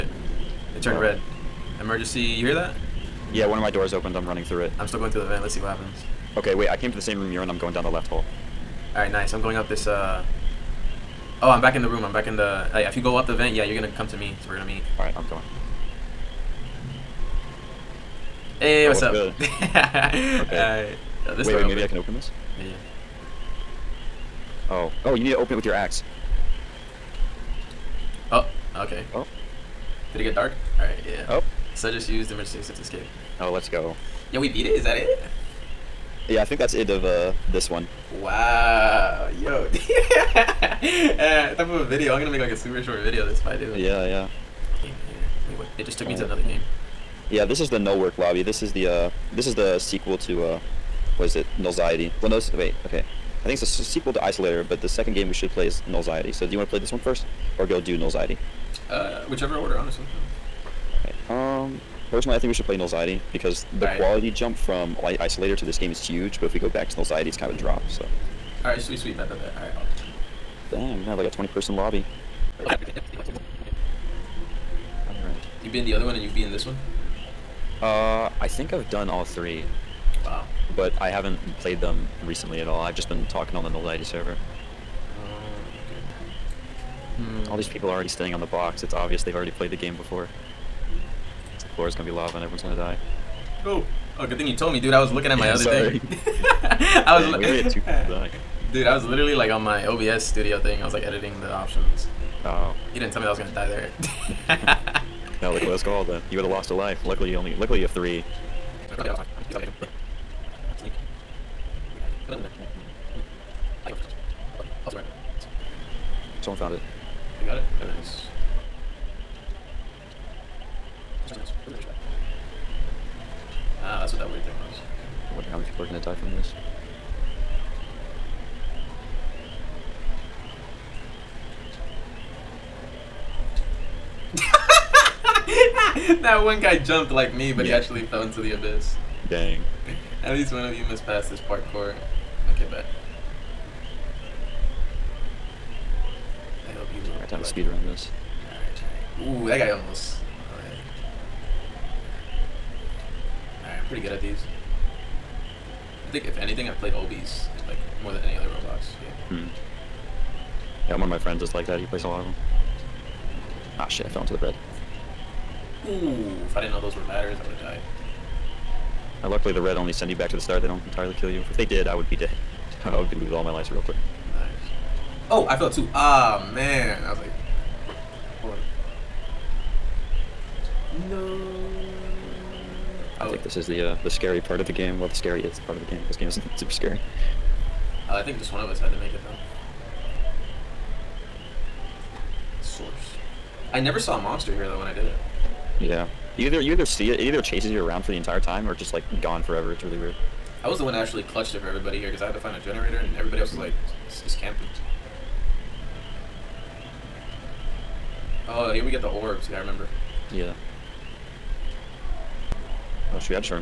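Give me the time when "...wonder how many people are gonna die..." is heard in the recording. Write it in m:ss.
2:05.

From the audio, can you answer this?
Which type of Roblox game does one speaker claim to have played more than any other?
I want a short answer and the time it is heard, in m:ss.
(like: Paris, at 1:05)
Obbies, at 2:36.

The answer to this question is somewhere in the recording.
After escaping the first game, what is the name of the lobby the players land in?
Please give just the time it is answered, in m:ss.
0:47.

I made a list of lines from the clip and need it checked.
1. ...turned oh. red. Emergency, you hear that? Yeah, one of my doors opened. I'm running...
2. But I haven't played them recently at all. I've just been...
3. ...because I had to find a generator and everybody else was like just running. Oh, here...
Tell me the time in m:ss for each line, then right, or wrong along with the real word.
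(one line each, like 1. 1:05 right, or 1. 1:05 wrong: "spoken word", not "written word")
1. 0:00 right
2. 1:20 right
3. 3:22 wrong: "camping", not "running".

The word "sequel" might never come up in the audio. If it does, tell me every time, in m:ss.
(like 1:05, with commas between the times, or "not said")
0:49, 0:53.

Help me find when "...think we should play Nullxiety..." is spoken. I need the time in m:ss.
1:02.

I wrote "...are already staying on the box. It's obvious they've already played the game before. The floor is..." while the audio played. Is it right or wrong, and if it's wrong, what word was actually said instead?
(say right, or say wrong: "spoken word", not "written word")
right.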